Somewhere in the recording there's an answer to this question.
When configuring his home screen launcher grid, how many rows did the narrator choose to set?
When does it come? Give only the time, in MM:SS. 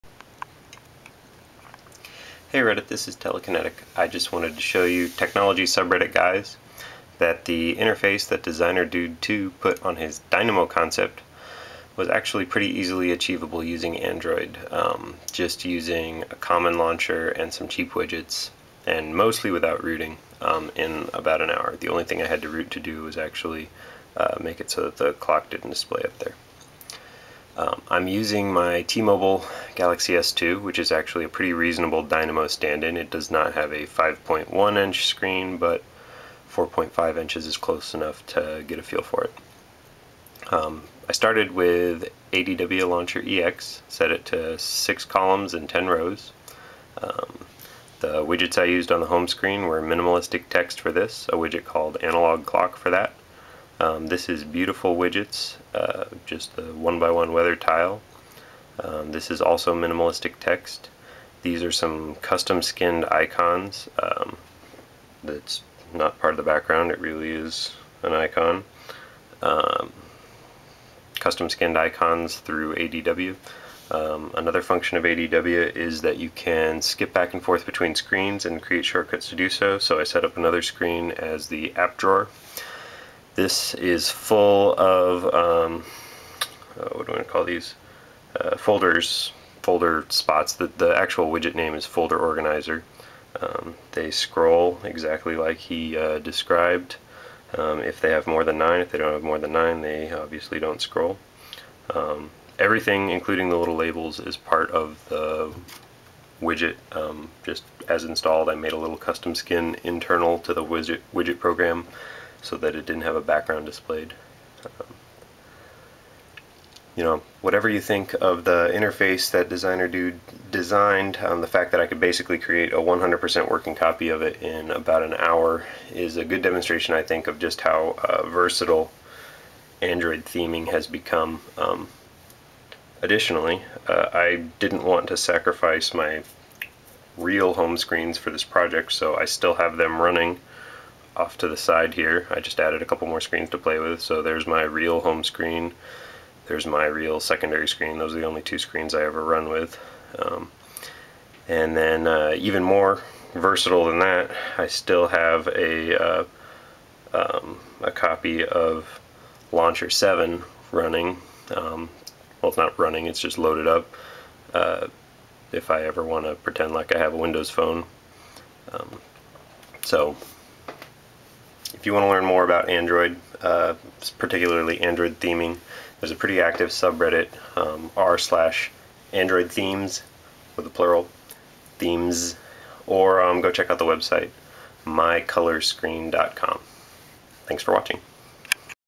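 00:45.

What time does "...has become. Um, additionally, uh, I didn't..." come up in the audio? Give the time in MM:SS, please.
02:10.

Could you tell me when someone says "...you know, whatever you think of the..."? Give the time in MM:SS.
01:56.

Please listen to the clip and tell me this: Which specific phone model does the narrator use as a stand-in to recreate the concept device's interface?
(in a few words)
T-Mobile Galaxy S2.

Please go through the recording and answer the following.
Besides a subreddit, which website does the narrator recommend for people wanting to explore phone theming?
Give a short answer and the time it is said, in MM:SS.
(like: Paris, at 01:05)
mycolorscreen.com, at 03:04.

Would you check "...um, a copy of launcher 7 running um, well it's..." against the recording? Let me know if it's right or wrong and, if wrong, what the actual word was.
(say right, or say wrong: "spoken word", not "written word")
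right.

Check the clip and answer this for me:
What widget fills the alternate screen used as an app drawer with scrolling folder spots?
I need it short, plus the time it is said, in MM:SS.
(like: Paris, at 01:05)
folder organizer, at 01:31.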